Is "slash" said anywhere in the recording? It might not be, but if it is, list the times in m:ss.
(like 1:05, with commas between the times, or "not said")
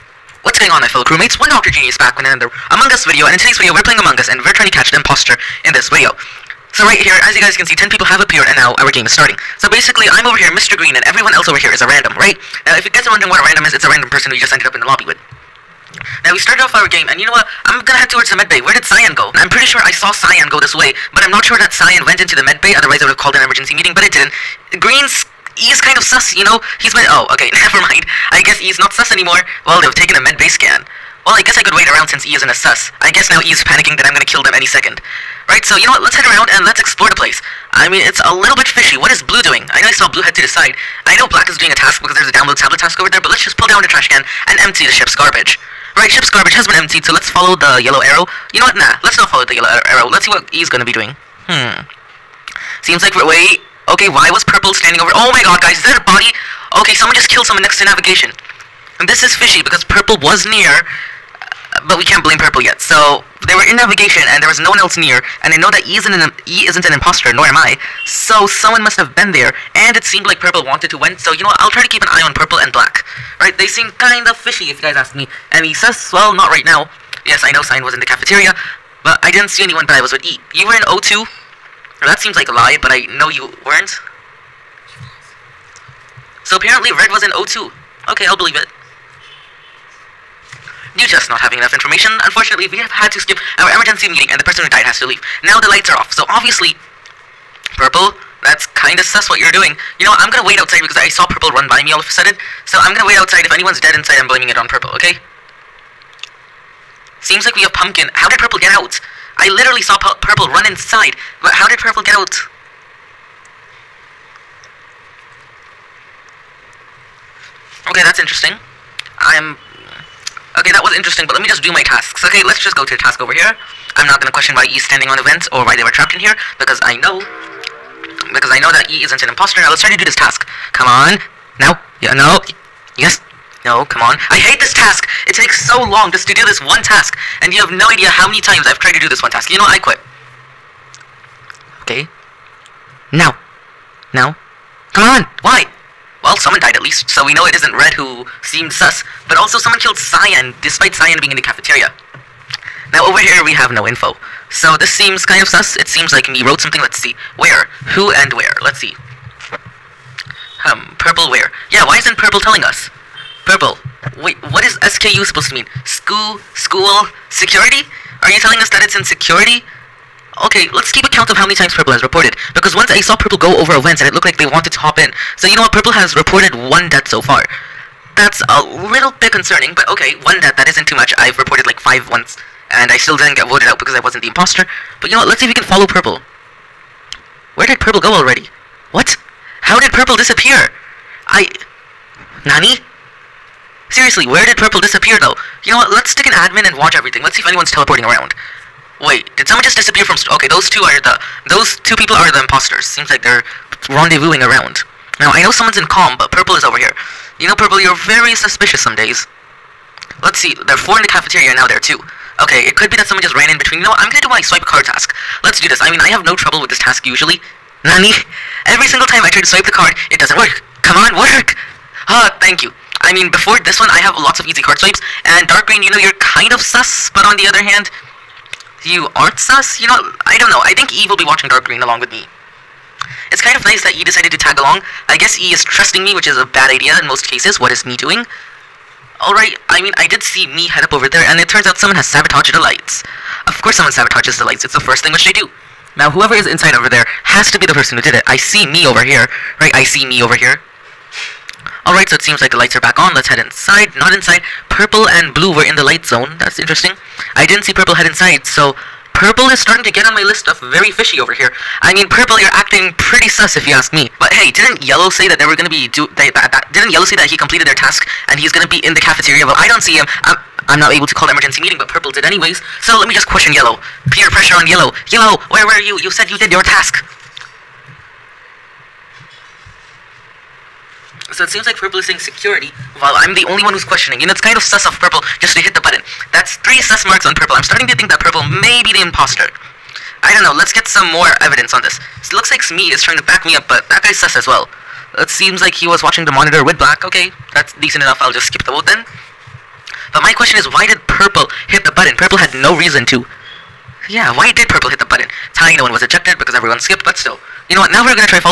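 not said.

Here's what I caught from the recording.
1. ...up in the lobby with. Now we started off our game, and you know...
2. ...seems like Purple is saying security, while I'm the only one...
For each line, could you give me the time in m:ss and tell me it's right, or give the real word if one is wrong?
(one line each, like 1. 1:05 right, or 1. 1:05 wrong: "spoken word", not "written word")
1. 0:14 right
2. 4:41 right.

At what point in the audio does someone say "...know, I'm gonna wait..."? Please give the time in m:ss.
1:40.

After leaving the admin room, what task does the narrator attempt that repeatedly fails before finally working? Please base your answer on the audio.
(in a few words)
Swipe a card.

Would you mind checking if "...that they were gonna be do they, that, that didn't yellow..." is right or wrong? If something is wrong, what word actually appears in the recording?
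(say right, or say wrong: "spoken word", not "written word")
right.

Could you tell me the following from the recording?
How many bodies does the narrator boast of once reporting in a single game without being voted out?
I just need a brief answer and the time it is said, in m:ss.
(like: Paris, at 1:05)
5, at 3:01.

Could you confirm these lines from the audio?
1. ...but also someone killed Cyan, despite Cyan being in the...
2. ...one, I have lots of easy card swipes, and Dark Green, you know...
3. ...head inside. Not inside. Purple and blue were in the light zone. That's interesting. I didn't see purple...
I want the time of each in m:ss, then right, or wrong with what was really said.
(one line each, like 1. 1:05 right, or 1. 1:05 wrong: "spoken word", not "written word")
1. 2:29 right
2. 3:43 right
3. 4:13 right.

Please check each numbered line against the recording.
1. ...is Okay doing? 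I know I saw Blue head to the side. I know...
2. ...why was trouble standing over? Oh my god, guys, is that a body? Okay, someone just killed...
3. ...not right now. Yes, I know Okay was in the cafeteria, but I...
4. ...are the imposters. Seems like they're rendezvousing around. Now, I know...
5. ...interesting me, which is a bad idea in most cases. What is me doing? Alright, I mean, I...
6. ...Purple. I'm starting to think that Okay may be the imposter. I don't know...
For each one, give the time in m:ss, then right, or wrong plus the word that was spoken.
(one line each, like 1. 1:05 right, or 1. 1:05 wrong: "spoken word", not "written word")
1. 0:39 wrong: "Blue", not "Okay"
2. 0:54 wrong: "purple", not "trouble"
3. 1:16 wrong: "Cyan", not "Okay"
4. 3:22 right
5. 3:55 wrong: "trusting", not "interesting"
6. 4:47 wrong: "Purple", not "Okay".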